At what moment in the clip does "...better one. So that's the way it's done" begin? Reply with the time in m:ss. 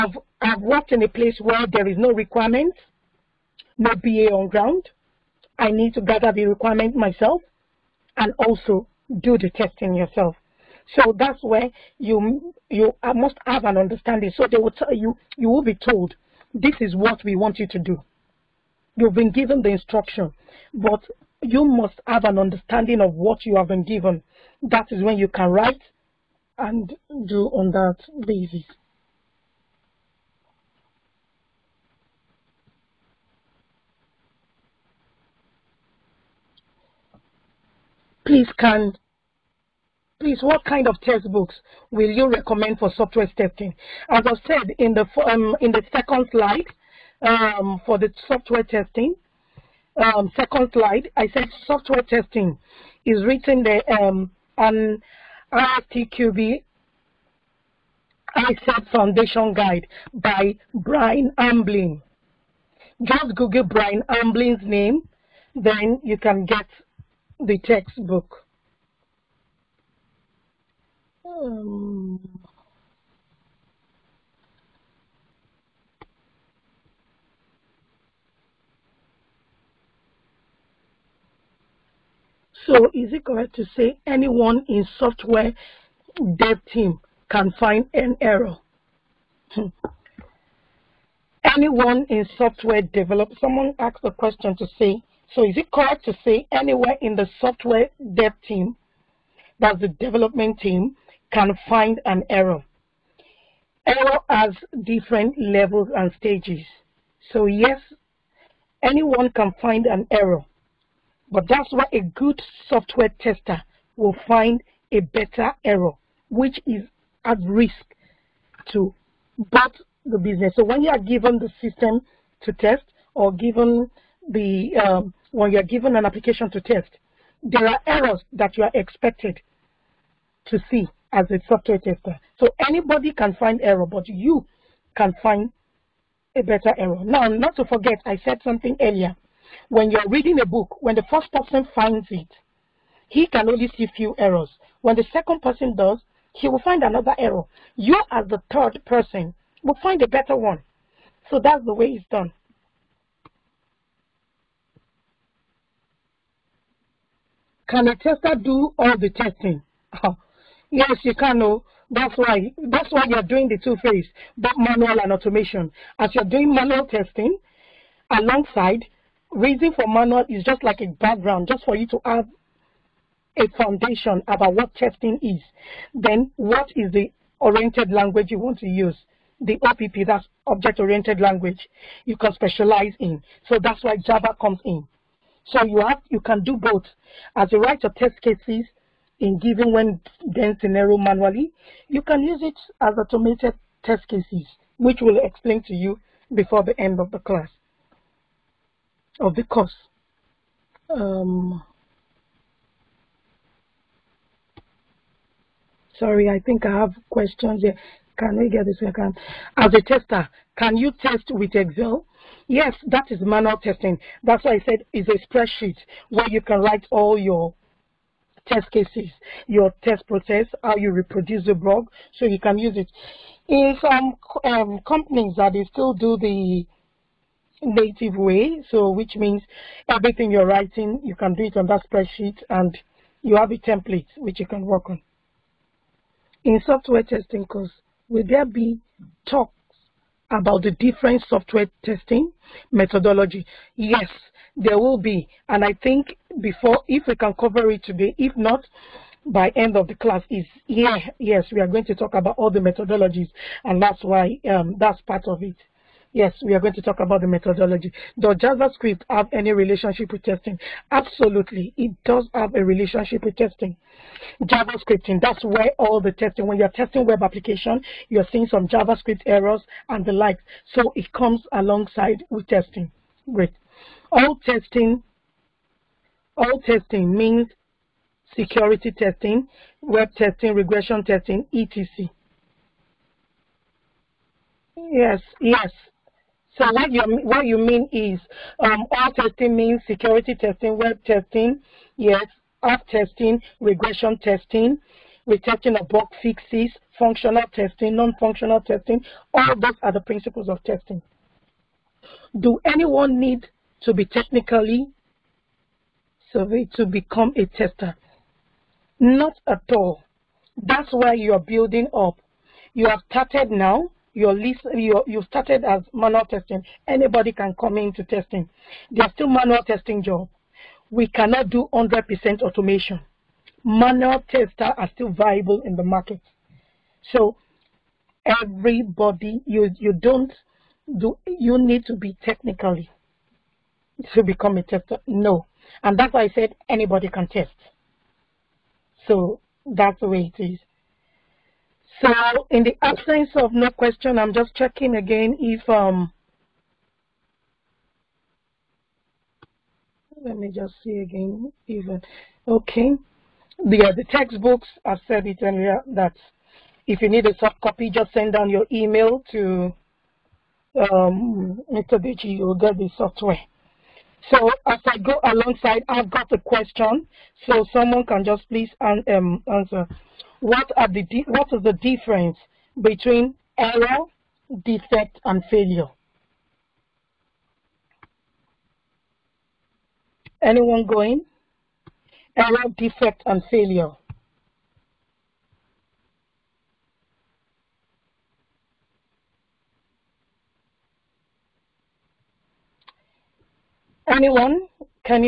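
2:30.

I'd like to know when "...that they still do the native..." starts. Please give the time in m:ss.
3:45.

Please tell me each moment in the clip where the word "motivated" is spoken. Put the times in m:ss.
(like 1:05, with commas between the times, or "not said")
not said.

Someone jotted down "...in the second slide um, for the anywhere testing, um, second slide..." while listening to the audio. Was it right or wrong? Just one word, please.
wrong.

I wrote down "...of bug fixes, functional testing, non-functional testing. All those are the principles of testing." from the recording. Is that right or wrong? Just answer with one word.
right.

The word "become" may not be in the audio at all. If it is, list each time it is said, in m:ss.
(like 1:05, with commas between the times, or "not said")
5:06, 5:34.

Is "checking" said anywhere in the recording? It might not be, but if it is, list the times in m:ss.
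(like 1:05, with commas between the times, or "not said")
5:44.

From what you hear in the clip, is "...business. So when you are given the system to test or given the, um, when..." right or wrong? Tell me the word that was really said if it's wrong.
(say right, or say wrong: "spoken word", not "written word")
right.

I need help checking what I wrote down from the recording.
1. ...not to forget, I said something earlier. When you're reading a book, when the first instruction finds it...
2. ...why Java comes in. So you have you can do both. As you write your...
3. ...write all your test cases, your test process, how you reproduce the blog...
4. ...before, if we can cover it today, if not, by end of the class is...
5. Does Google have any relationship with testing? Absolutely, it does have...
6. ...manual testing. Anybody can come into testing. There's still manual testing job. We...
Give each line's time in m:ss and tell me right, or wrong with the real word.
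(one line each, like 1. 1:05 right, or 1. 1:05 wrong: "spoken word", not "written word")
1. 2:17 wrong: "person", not "instruction"
2. 3:03 right
3. 3:36 right
4. 4:06 right
5. 4:18 wrong: "JavaScript", not "Google"
6. 5:15 right.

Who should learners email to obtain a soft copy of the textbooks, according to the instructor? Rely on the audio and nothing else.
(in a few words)
Mr. Deji.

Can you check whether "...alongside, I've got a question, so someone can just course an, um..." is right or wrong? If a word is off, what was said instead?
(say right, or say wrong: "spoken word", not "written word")
wrong: "please", not "course".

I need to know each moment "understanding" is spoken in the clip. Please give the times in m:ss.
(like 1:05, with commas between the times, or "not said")
0:13, 0:22.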